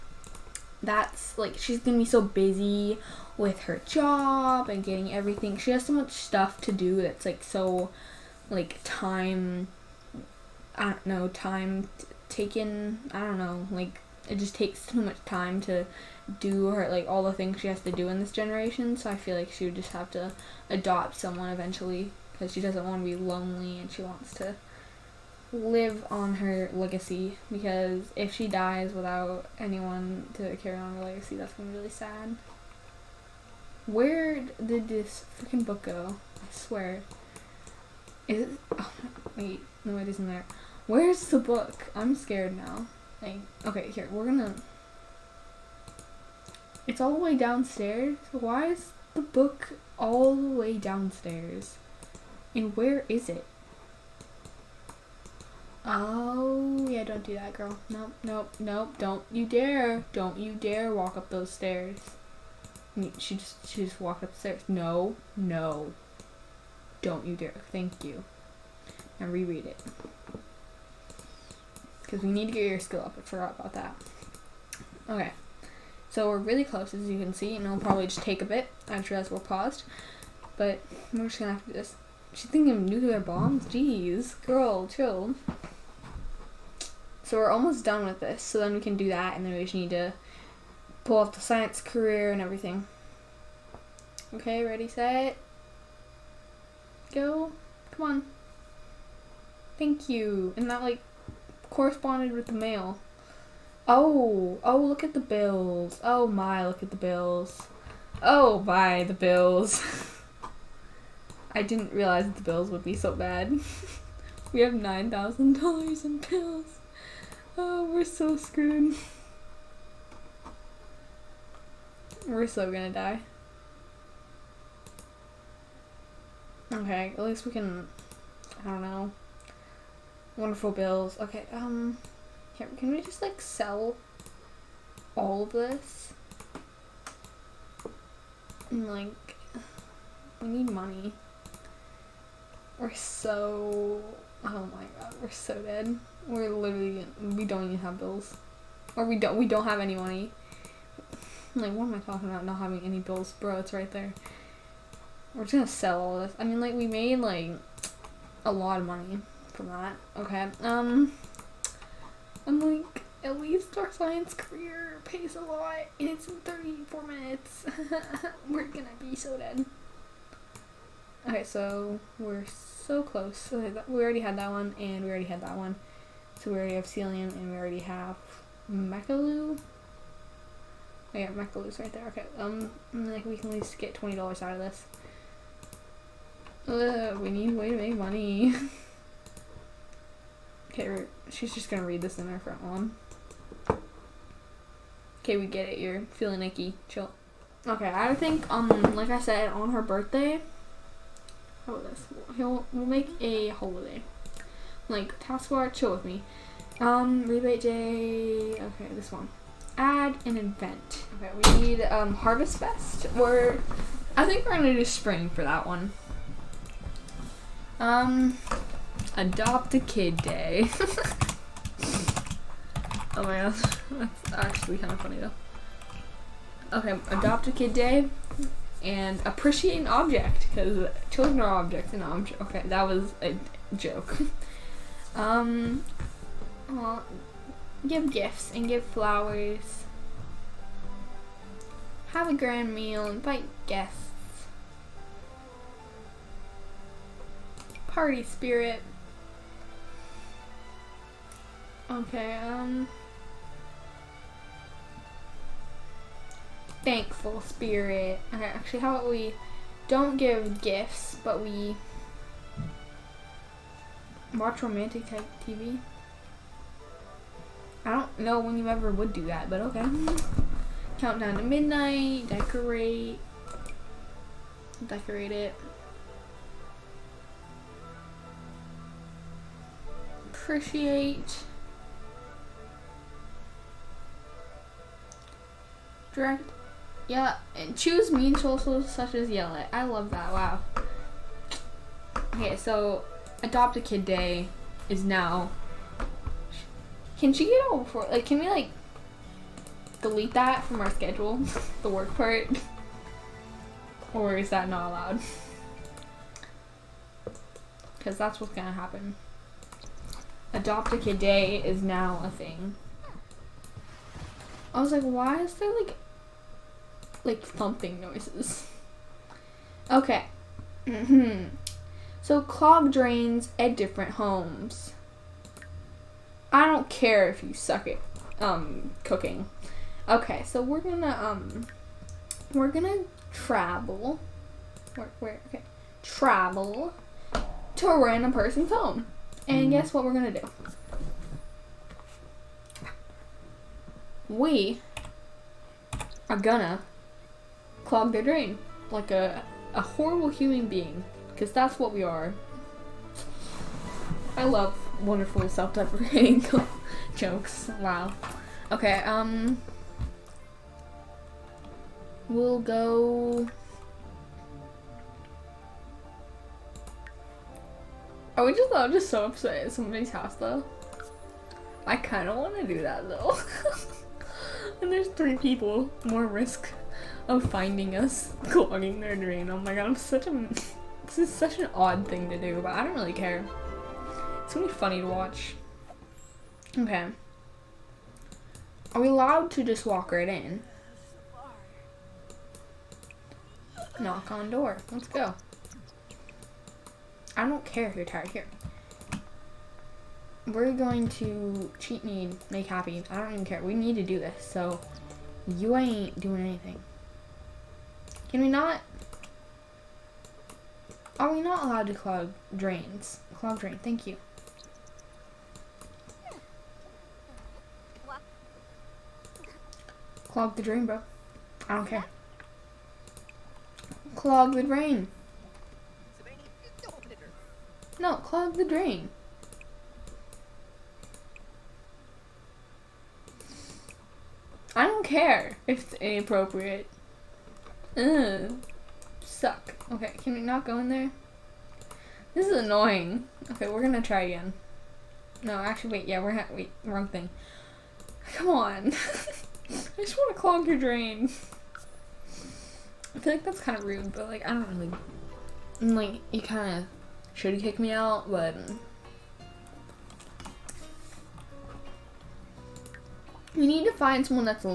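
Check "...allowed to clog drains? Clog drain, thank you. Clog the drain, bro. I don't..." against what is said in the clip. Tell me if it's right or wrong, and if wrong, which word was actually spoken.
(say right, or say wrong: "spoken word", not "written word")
right.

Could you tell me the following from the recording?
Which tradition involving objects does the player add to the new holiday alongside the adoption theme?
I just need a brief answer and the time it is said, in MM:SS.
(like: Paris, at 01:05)
Appreciate an Object, at 03:49.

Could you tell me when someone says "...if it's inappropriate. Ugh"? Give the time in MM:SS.
07:15.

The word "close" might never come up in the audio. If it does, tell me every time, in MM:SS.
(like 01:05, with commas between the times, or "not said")
01:16, 02:53.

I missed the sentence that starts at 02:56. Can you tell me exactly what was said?
So we already have Celium, and we already have Mechaloo.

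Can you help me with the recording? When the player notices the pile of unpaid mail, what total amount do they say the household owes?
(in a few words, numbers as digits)
$9,000.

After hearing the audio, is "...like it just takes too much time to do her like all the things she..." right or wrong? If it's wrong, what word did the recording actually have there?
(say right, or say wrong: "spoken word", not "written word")
right.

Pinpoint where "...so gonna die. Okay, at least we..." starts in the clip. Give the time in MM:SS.
02:02.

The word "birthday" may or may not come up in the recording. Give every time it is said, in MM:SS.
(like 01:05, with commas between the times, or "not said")
03:19.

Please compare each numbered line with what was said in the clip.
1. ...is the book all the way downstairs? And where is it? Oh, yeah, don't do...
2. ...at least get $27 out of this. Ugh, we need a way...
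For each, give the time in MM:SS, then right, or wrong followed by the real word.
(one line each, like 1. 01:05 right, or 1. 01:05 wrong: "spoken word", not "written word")
1. 00:48 right
2. 03:03 wrong: "20", not "27".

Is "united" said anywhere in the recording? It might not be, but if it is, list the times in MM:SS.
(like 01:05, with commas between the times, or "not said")
not said.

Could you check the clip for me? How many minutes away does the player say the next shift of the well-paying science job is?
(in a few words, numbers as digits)
34.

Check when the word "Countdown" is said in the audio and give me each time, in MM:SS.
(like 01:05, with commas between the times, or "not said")
04:30.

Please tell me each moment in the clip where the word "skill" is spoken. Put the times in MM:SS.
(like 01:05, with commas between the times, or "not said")
01:12.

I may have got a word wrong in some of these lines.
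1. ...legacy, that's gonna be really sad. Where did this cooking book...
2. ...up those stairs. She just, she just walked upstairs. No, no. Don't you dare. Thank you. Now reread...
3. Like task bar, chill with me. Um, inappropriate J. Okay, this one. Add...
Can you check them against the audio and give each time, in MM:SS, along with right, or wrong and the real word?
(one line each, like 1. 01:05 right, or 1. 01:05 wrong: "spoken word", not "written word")
1. 00:31 wrong: "freaking", not "cooking"
2. 01:01 right
3. 03:24 wrong: "rebate", not "inappropriate".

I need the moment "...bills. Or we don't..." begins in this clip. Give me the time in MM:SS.
02:27.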